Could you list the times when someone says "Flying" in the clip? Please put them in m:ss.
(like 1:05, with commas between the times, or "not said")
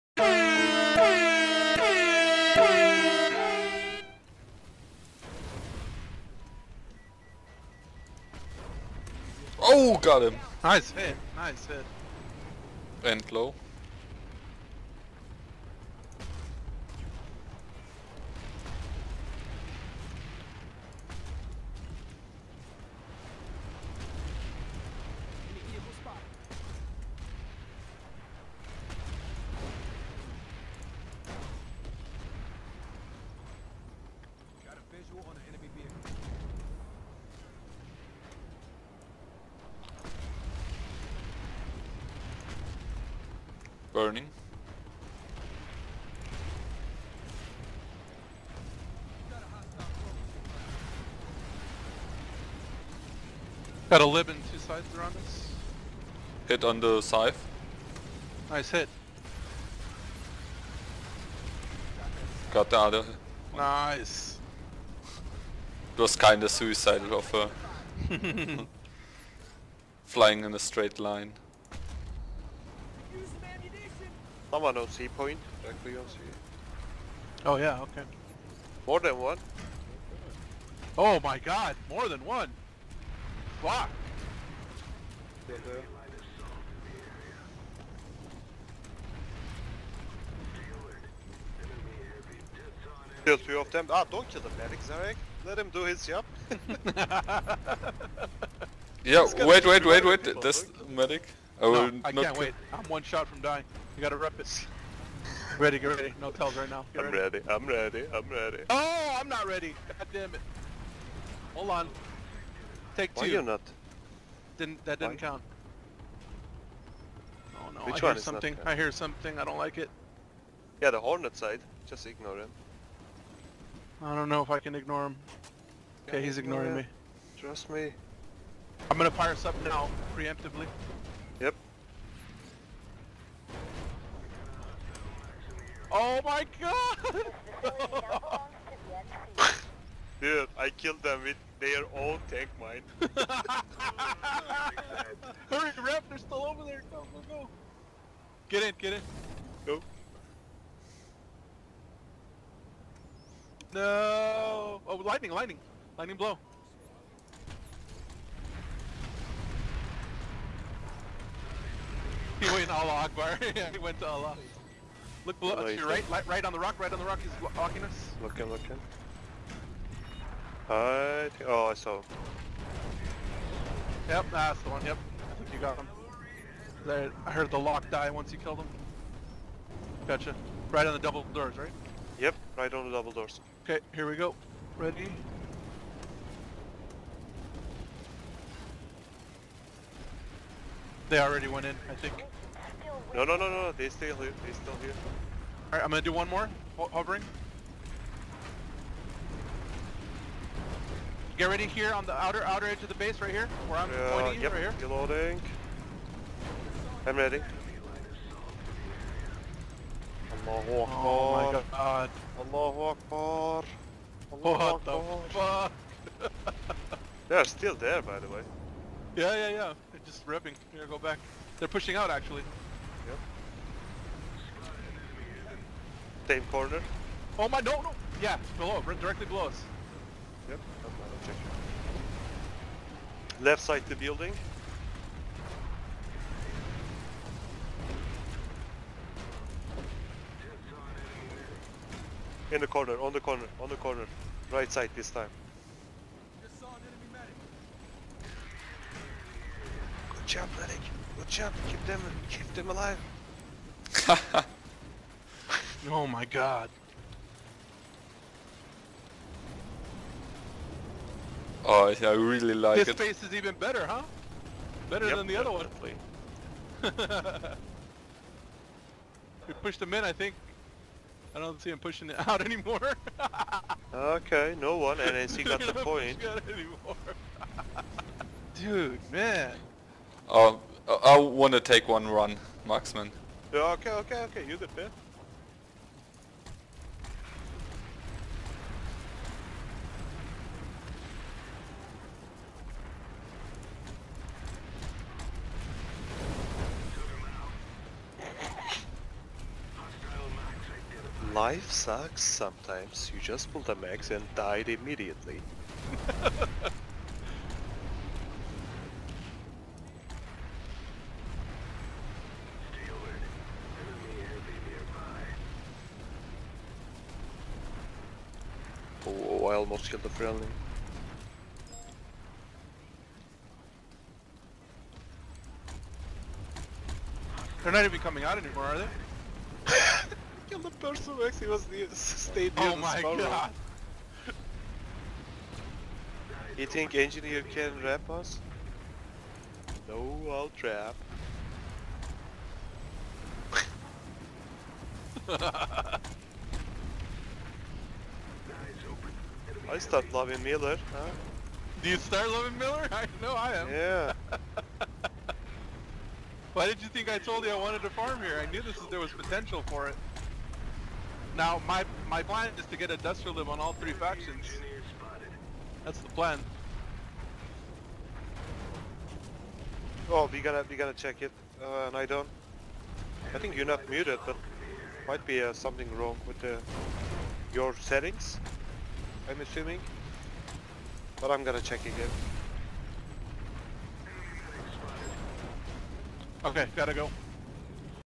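1:10.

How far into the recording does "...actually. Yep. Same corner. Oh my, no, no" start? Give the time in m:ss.
3:42.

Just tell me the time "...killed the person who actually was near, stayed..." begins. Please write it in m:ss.
5:30.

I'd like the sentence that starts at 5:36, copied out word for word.
You think engineer can wrap us?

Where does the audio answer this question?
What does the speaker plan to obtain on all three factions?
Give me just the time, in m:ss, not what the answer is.
6:02.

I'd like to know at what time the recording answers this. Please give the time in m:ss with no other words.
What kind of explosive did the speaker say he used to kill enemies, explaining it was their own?
2:22.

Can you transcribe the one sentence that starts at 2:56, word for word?
There, I heard the lock die once you killed him.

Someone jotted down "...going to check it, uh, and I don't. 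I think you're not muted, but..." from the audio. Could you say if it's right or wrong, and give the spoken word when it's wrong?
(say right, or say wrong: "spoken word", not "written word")
right.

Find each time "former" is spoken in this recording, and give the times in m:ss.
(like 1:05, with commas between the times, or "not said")
not said.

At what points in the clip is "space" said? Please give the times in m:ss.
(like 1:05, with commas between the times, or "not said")
4:23.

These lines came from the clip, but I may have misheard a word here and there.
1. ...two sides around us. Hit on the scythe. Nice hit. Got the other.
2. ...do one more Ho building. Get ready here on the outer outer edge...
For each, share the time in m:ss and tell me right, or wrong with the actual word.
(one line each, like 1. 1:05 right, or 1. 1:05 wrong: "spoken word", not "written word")
1. 0:54 right
2. 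3:16 wrong: "hovering", not "building".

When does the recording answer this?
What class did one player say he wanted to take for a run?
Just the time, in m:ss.
4:42.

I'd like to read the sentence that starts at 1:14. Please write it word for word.
Someone on C point, directly on C.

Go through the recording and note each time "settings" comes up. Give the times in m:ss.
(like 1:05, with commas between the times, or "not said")
6:17.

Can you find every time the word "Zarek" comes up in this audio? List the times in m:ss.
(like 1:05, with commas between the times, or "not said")
1:34.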